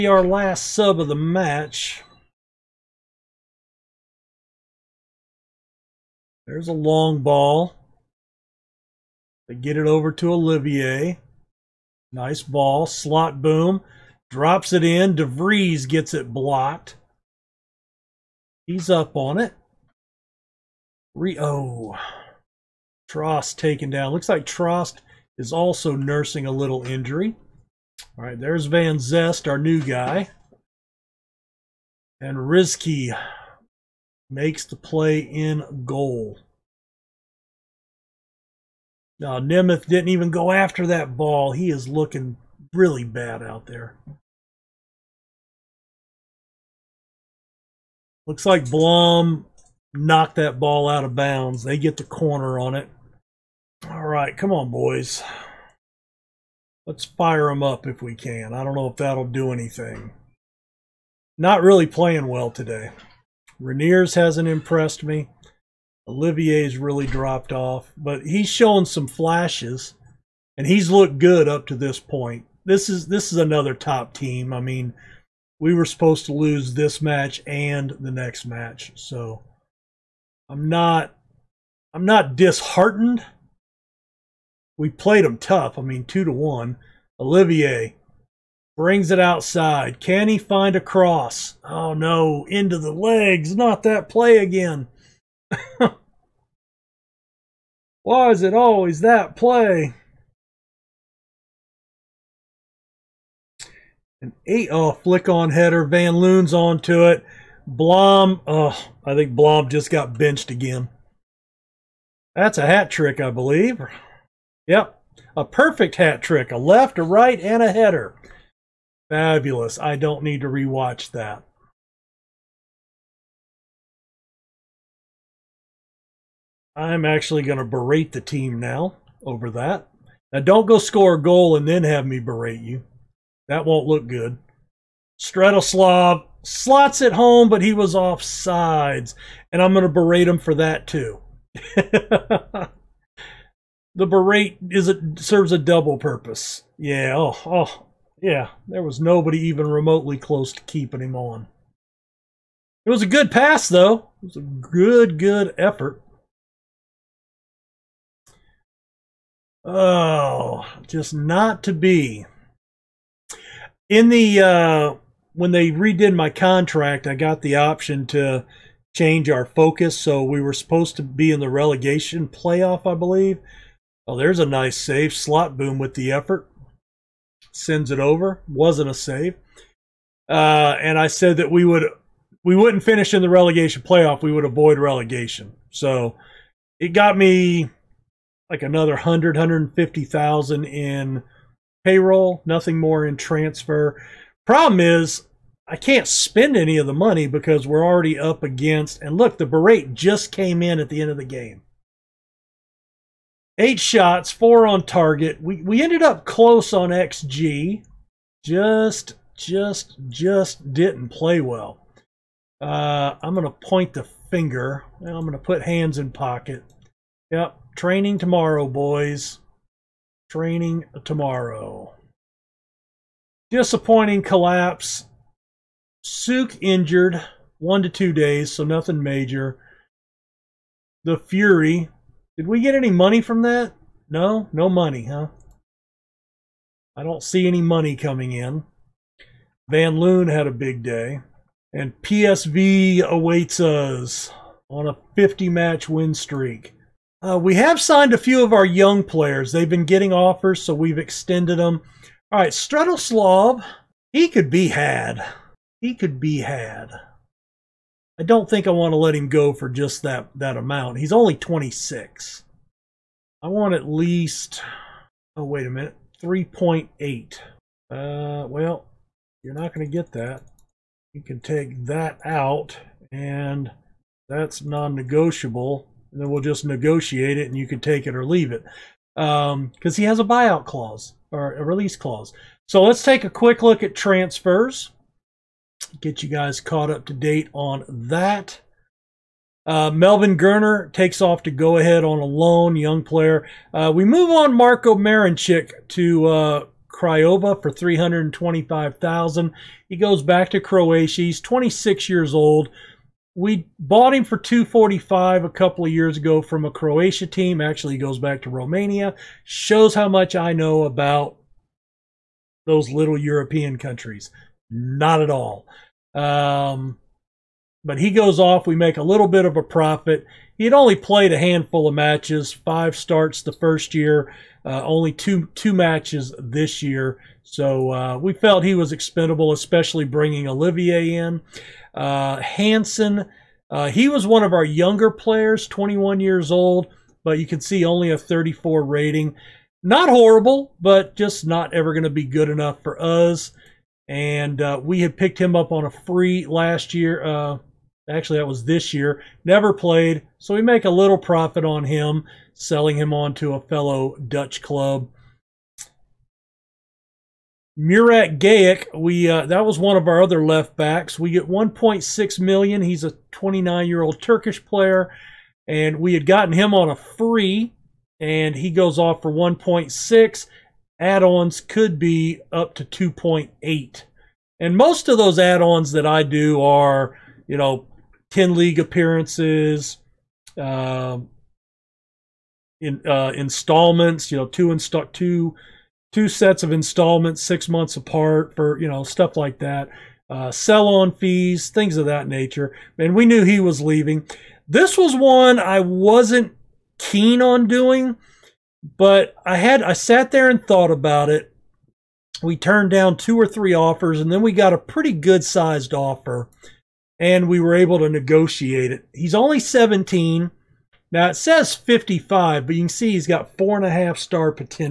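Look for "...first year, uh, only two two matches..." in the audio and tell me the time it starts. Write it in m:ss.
5:23.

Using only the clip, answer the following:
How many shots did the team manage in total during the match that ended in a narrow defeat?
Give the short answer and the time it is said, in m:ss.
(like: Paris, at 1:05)
8, at 3:23.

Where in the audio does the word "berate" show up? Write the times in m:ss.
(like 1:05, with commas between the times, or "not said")
2:07, 2:12, 2:19, 2:24, 3:19.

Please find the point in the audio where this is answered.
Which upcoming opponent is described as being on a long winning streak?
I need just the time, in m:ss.
4:02.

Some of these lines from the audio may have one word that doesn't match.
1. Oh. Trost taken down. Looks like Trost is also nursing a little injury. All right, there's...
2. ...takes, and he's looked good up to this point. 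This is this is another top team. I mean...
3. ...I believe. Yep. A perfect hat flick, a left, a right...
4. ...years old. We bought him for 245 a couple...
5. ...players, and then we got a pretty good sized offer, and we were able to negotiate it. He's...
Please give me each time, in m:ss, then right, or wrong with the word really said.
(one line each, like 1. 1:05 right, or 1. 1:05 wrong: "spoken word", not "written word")
1. 0:21 right
2. 1:09 wrong: "flashes", not "takes"
3. 1:53 wrong: "trick", not "flick"
4. 5:02 right
5. 6:43 wrong: "offers", not "players".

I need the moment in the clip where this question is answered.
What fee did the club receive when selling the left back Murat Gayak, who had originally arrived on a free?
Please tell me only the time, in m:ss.
6:01.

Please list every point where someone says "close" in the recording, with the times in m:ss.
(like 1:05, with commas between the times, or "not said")
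2:30, 3:26.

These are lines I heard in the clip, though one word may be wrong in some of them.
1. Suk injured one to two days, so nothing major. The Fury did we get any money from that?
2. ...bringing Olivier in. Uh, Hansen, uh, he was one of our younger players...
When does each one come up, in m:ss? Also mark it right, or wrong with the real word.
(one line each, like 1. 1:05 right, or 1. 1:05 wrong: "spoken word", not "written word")
1. 3:46 right
2. 5:30 right.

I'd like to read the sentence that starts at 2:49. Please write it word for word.
So we were supposed to be in the relegation playoff, I believe Oh, there's a nice save.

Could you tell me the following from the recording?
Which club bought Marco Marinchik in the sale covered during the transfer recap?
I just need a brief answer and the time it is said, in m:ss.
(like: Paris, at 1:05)
Craiova, at 4:56.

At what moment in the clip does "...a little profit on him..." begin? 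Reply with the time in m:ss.
5:50.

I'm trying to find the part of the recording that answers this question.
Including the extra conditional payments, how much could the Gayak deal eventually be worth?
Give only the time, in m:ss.
6:12.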